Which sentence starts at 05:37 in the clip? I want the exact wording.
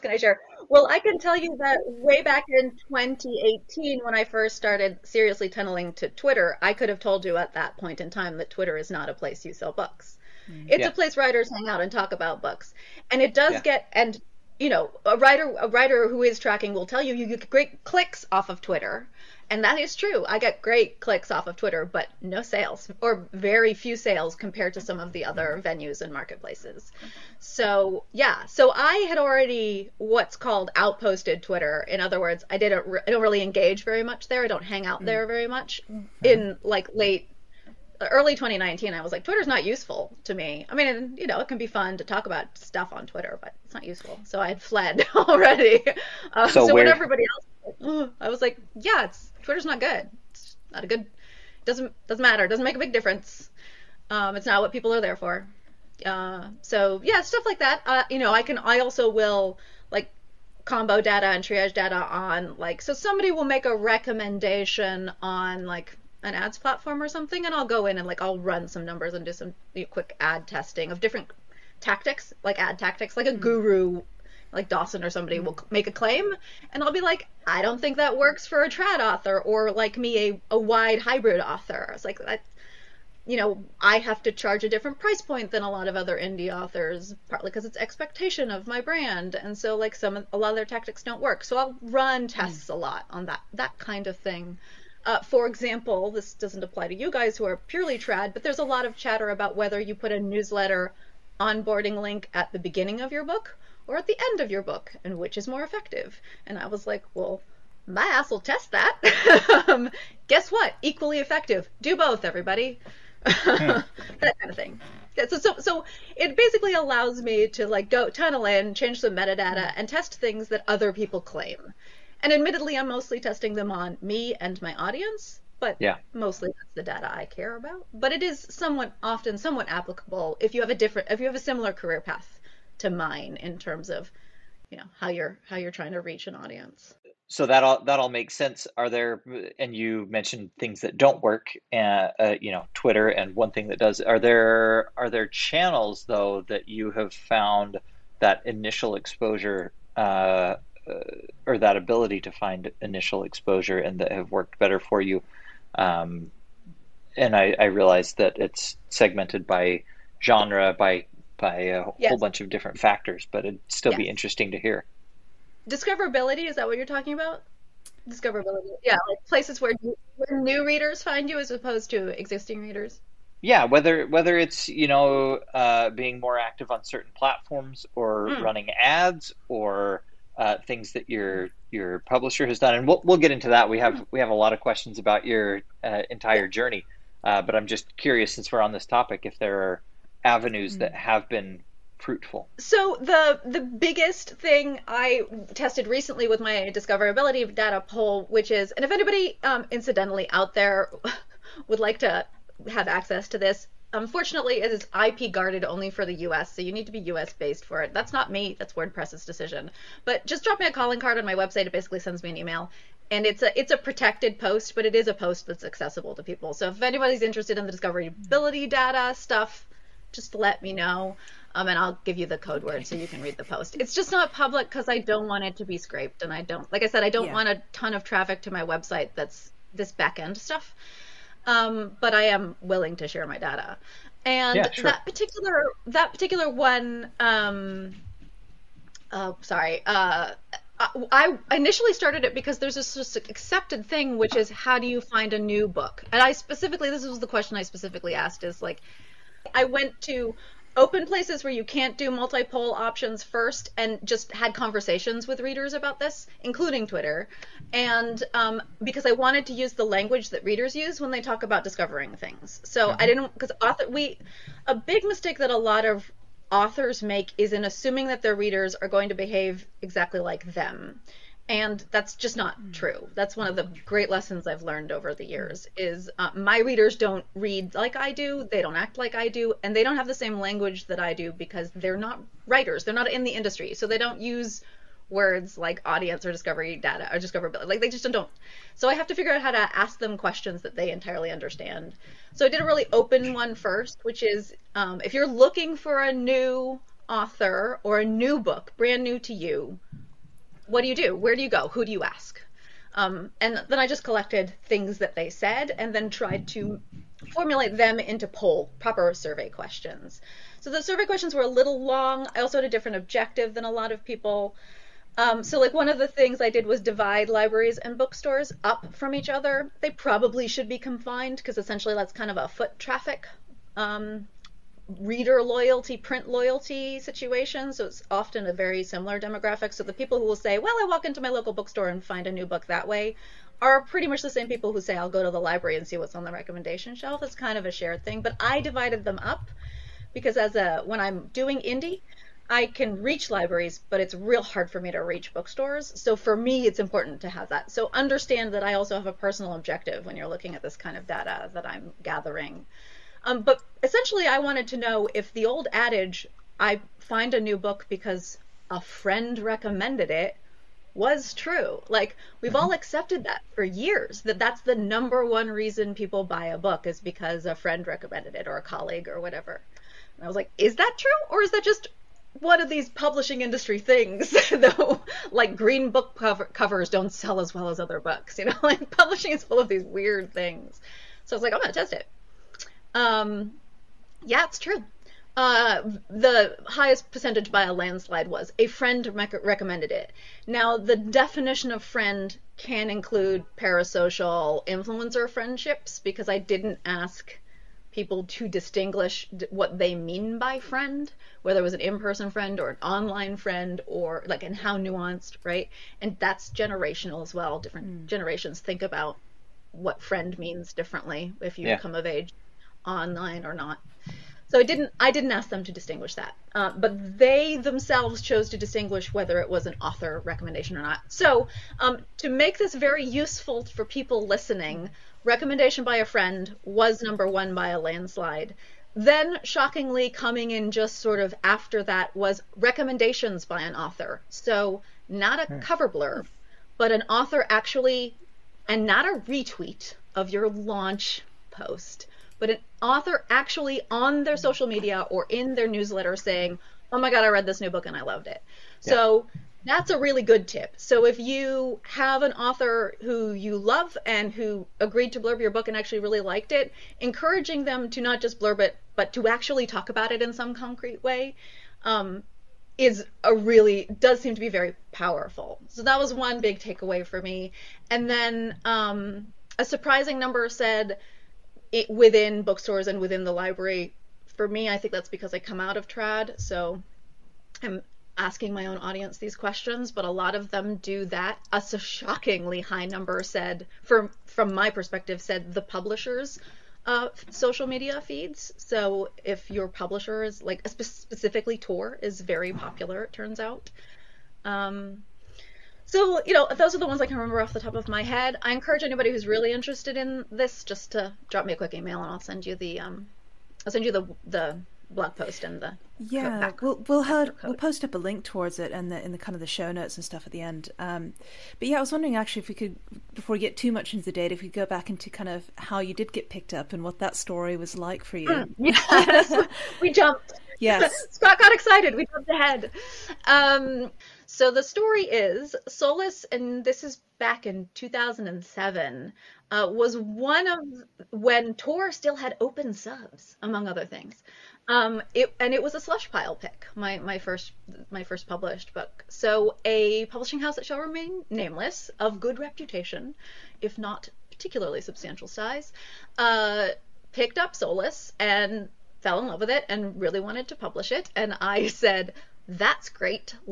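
It's kind of a shared thing.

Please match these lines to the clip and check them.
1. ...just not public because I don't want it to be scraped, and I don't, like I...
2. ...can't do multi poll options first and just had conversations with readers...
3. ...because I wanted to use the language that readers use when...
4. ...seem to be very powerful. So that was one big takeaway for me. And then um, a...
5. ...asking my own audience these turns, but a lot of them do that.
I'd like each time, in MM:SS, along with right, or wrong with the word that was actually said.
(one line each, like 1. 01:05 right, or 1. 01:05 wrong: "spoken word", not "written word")
1. 03:43 right
2. 04:11 right
3. 04:18 right
4. 07:44 right
5. 07:58 wrong: "questions", not "turns".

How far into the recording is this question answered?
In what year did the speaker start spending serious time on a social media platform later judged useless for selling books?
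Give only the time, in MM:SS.
00:02.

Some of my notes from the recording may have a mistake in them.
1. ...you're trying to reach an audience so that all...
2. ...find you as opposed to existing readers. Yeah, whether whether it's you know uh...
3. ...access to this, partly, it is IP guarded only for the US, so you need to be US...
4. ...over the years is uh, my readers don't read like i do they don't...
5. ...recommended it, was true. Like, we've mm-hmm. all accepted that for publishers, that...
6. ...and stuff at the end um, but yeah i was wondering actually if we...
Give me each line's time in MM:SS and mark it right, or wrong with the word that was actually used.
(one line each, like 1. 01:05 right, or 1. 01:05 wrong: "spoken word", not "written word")
1. 02:15 right
2. 02:51 right
3. 03:22 wrong: "unfortunately", not "partly"
4. 04:34 right
5. 05:59 wrong: "years", not "publishers"
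6. 08:29 right.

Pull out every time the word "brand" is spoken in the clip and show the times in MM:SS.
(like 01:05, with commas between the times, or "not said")
01:28, 04:58.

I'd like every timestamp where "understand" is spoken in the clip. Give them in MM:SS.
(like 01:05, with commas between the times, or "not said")
04:51, 05:47.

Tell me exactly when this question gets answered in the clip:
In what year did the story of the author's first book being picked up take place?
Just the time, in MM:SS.
08:47.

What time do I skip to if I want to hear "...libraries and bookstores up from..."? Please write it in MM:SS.
05:17.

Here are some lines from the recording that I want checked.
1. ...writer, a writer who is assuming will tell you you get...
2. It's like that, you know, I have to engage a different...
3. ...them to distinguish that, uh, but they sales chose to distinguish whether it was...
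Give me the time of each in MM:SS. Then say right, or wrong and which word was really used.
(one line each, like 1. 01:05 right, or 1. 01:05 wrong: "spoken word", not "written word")
1. 00:15 wrong: "tracking", not "assuming"
2. 01:21 wrong: "charge", not "engage"
3. 06:55 wrong: "themselves", not "sales".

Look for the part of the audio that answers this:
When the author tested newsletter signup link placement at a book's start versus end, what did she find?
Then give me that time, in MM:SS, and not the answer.
01:50.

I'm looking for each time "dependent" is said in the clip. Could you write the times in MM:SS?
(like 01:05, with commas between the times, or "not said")
not said.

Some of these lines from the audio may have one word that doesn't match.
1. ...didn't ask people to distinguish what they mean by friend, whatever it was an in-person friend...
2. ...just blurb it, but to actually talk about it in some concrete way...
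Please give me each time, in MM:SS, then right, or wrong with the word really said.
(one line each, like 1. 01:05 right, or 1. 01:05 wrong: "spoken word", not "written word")
1. 06:36 wrong: "whether", not "whatever"
2. 07:38 right.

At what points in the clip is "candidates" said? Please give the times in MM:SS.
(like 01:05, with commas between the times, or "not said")
not said.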